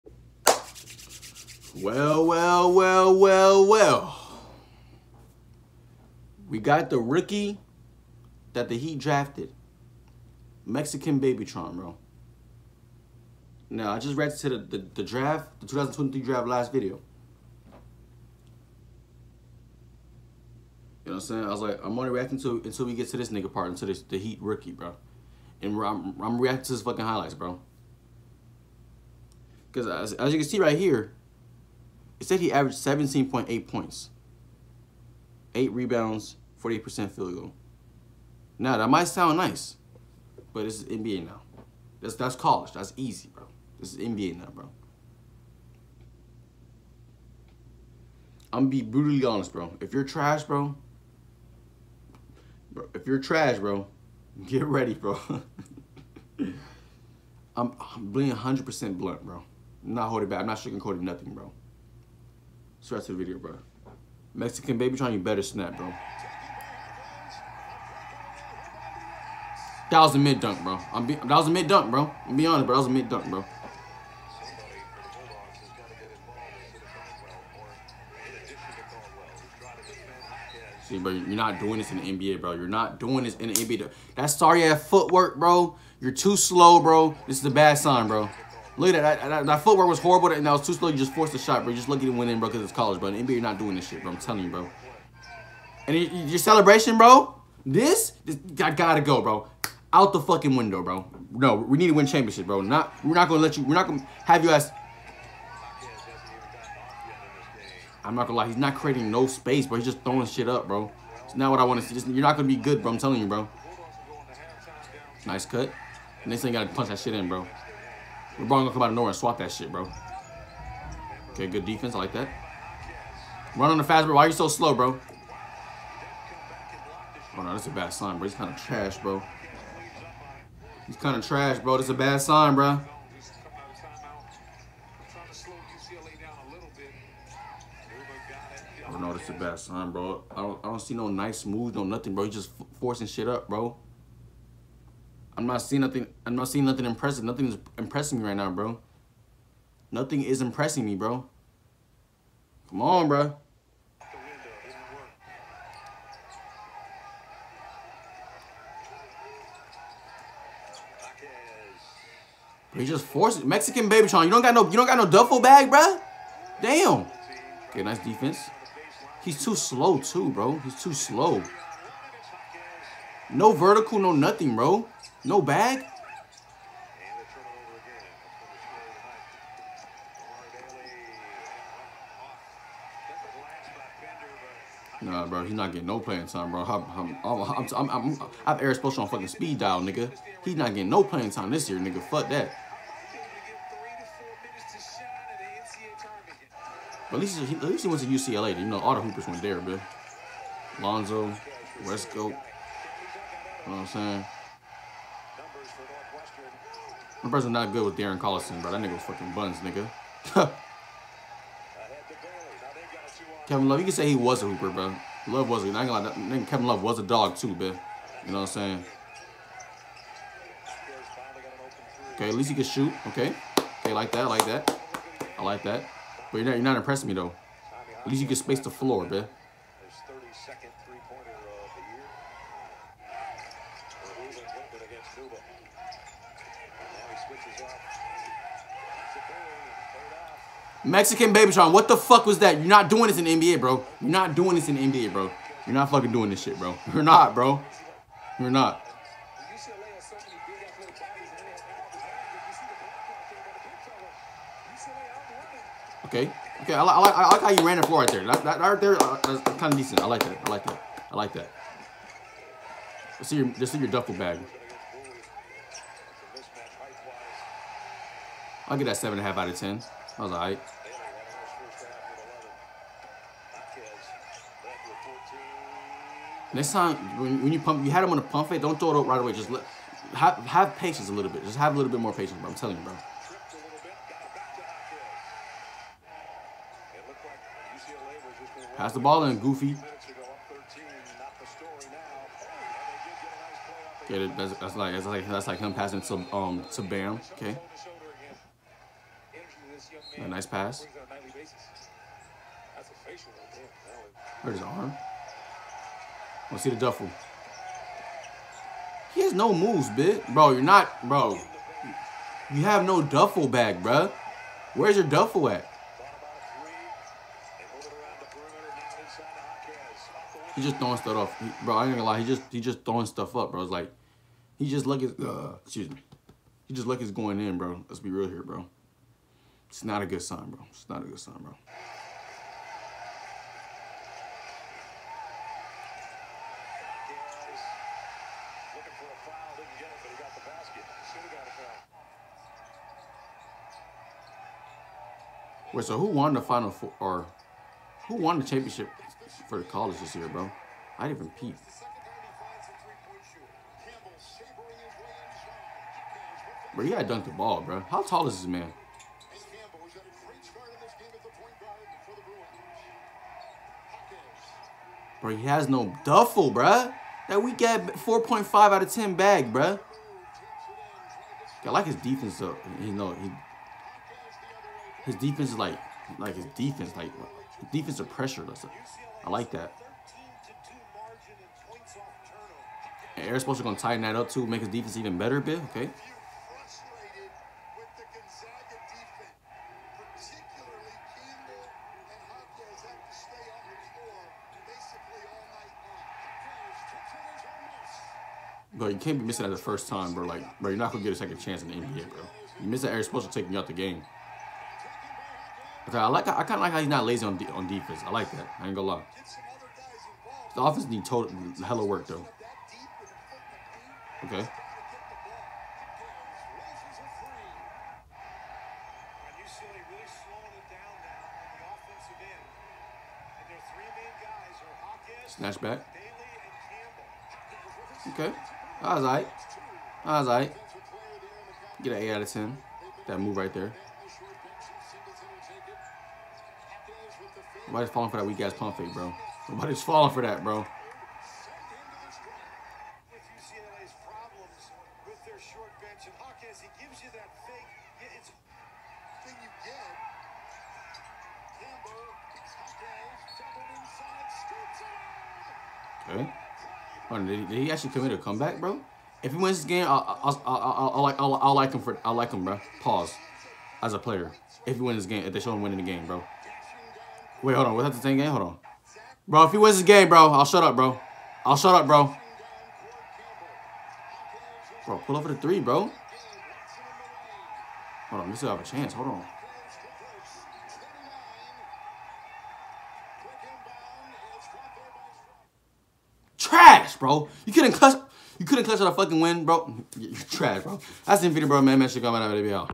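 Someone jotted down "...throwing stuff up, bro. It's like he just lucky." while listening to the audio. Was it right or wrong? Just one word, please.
right.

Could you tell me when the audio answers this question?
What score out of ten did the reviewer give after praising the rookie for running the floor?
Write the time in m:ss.
4:28.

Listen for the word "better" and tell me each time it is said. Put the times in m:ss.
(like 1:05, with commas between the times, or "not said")
1:05, 6:25.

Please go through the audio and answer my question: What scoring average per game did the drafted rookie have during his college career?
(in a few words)
17.8 points.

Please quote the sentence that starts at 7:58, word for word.
Hold on, we still have a chance.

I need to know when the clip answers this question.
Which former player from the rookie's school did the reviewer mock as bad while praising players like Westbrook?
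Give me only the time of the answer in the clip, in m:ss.
3:27.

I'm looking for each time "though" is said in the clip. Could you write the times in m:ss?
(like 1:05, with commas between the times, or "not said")
3:47, 6:12, 6:52.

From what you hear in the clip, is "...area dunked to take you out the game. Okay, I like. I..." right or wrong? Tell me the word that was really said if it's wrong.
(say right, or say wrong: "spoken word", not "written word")
wrong: "supposed", not "dunked".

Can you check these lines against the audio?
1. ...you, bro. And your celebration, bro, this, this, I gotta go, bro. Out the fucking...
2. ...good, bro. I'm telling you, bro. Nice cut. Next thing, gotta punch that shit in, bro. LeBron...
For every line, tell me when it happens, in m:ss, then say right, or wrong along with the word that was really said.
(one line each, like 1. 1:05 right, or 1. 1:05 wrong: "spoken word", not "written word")
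1. 1:34 right
2. 1:52 right.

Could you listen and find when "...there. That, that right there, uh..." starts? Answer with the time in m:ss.
4:18.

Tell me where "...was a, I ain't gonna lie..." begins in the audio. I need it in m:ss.
3:35.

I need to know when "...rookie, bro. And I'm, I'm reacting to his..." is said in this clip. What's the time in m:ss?
0:24.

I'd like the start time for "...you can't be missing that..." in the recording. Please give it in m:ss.
6:38.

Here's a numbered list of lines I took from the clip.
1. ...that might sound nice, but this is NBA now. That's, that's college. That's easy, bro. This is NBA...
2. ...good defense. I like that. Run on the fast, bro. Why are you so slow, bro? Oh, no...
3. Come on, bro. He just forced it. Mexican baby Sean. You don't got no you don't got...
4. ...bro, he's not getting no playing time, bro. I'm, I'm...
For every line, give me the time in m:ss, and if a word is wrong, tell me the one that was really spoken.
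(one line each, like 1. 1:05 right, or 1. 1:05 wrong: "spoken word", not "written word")
1. 0:38 right
2. 2:01 right
3. 2:32 right
4. 3:05 right.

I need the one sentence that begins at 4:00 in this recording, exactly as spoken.
Mexican Babytron, what the fuck was that?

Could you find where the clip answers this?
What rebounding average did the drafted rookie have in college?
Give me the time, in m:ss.
0:35.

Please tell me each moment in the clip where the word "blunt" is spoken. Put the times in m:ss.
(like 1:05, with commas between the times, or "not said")
0:58.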